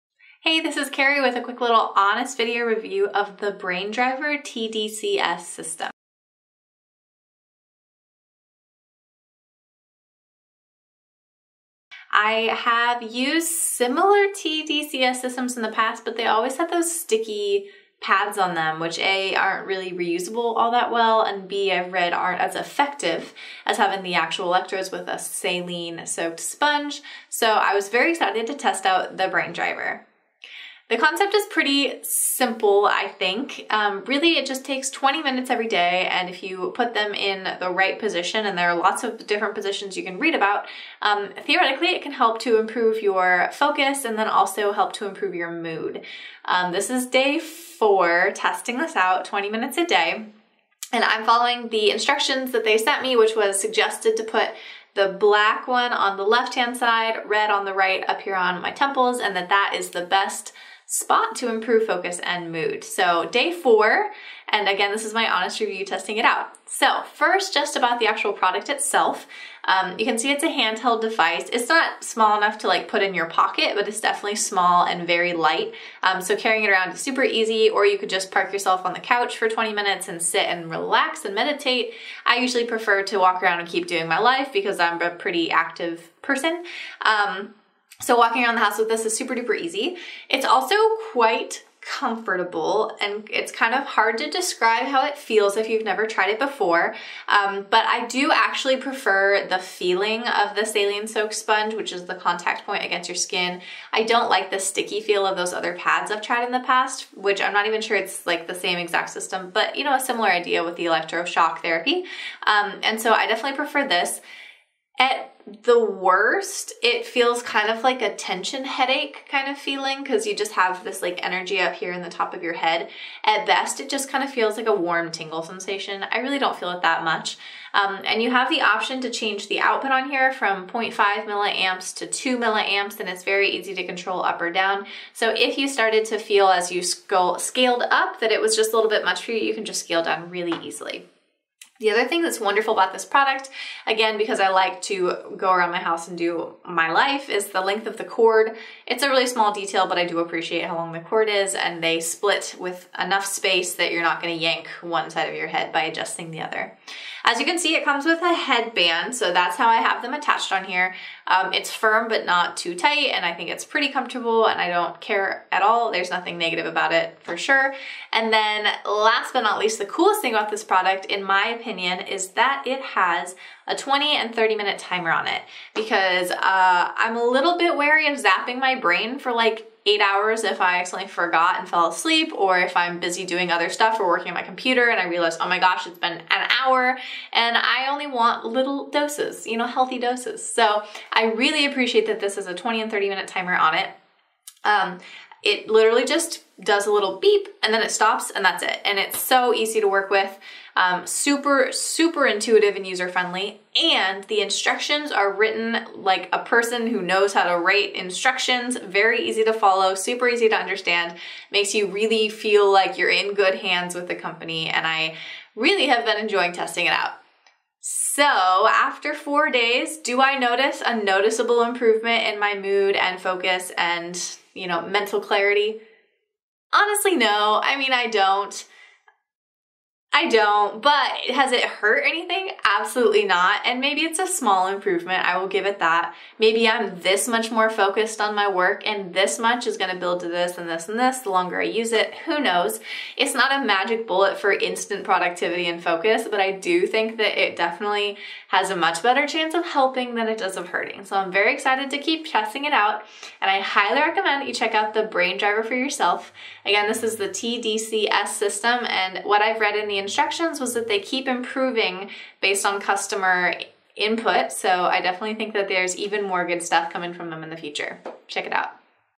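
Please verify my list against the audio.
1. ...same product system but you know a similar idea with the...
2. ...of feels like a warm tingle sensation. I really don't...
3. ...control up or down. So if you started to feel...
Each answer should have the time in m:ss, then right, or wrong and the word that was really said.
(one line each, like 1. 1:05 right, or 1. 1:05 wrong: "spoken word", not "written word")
1. 1:48 wrong: "exact", not "product"
2. 2:04 right
3. 2:13 right.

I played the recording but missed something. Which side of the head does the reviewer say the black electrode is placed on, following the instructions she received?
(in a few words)
Left.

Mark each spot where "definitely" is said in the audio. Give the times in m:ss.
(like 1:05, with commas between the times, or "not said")
1:14, 1:53, 4:07, 4:25.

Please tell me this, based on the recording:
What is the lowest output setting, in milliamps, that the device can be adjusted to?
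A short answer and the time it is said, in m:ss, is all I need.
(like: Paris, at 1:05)
0.5 milliamps, at 2:10.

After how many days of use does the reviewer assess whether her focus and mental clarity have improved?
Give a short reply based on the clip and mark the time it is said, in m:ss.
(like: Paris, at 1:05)
4, at 3:39.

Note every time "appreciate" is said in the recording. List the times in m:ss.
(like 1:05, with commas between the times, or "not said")
2:30, 3:11.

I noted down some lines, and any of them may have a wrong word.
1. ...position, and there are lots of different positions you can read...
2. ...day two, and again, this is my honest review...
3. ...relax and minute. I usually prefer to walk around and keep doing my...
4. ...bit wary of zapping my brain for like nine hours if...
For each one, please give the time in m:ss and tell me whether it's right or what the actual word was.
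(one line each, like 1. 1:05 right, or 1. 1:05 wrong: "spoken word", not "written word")
1. 0:37 right
2. 1:03 wrong: "four", not "two"
3. 1:20 wrong: "meditate", not "minute"
4. 2:57 wrong: "eight", not "nine".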